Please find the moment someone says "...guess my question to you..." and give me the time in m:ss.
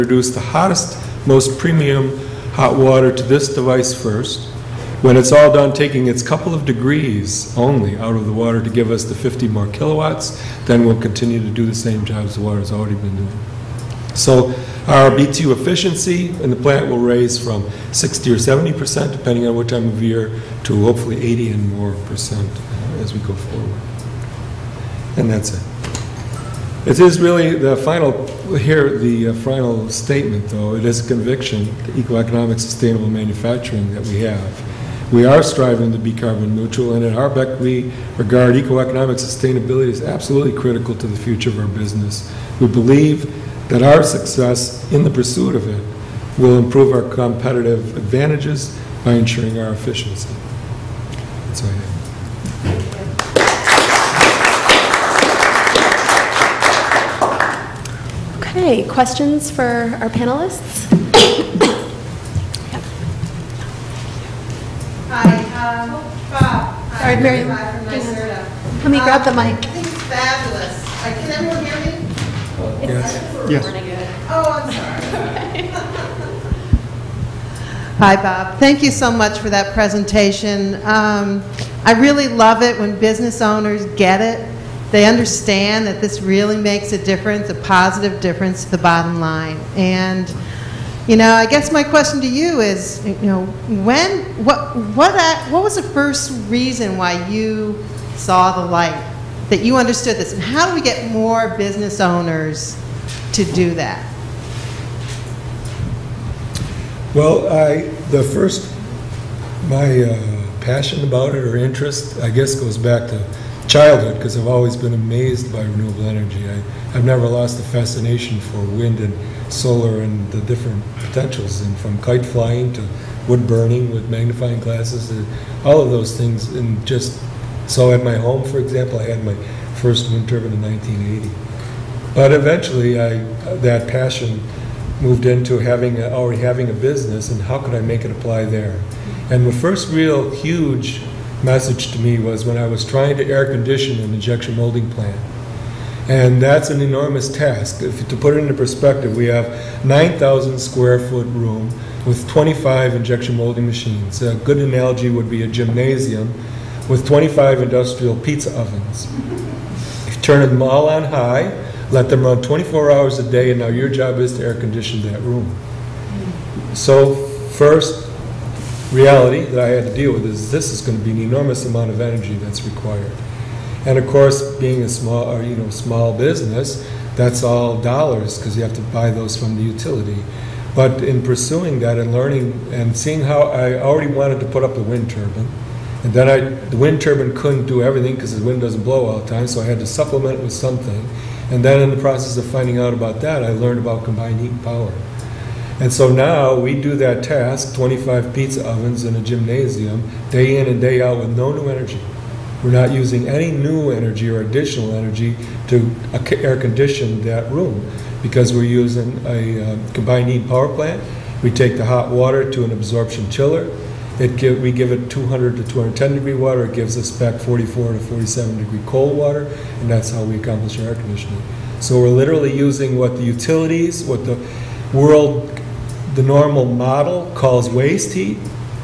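1:31.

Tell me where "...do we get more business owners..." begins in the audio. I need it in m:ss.
1:40.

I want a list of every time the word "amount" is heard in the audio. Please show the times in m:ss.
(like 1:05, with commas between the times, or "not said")
2:51.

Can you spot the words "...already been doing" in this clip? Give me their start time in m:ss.
0:12.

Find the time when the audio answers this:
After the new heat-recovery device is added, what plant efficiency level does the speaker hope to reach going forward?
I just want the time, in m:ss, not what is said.
0:21.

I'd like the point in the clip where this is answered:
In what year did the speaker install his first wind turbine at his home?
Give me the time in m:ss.
2:10.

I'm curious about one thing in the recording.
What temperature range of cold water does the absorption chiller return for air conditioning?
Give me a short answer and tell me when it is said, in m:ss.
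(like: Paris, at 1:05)
44 to 47 degrees, at 3:37.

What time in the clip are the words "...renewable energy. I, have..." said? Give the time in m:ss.
1:55.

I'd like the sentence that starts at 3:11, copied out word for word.
And then in the process of finding out about that, I learned about combined heat and power.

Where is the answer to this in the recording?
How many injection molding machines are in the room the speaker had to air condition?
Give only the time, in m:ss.
2:32.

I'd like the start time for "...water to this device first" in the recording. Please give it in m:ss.
0:02.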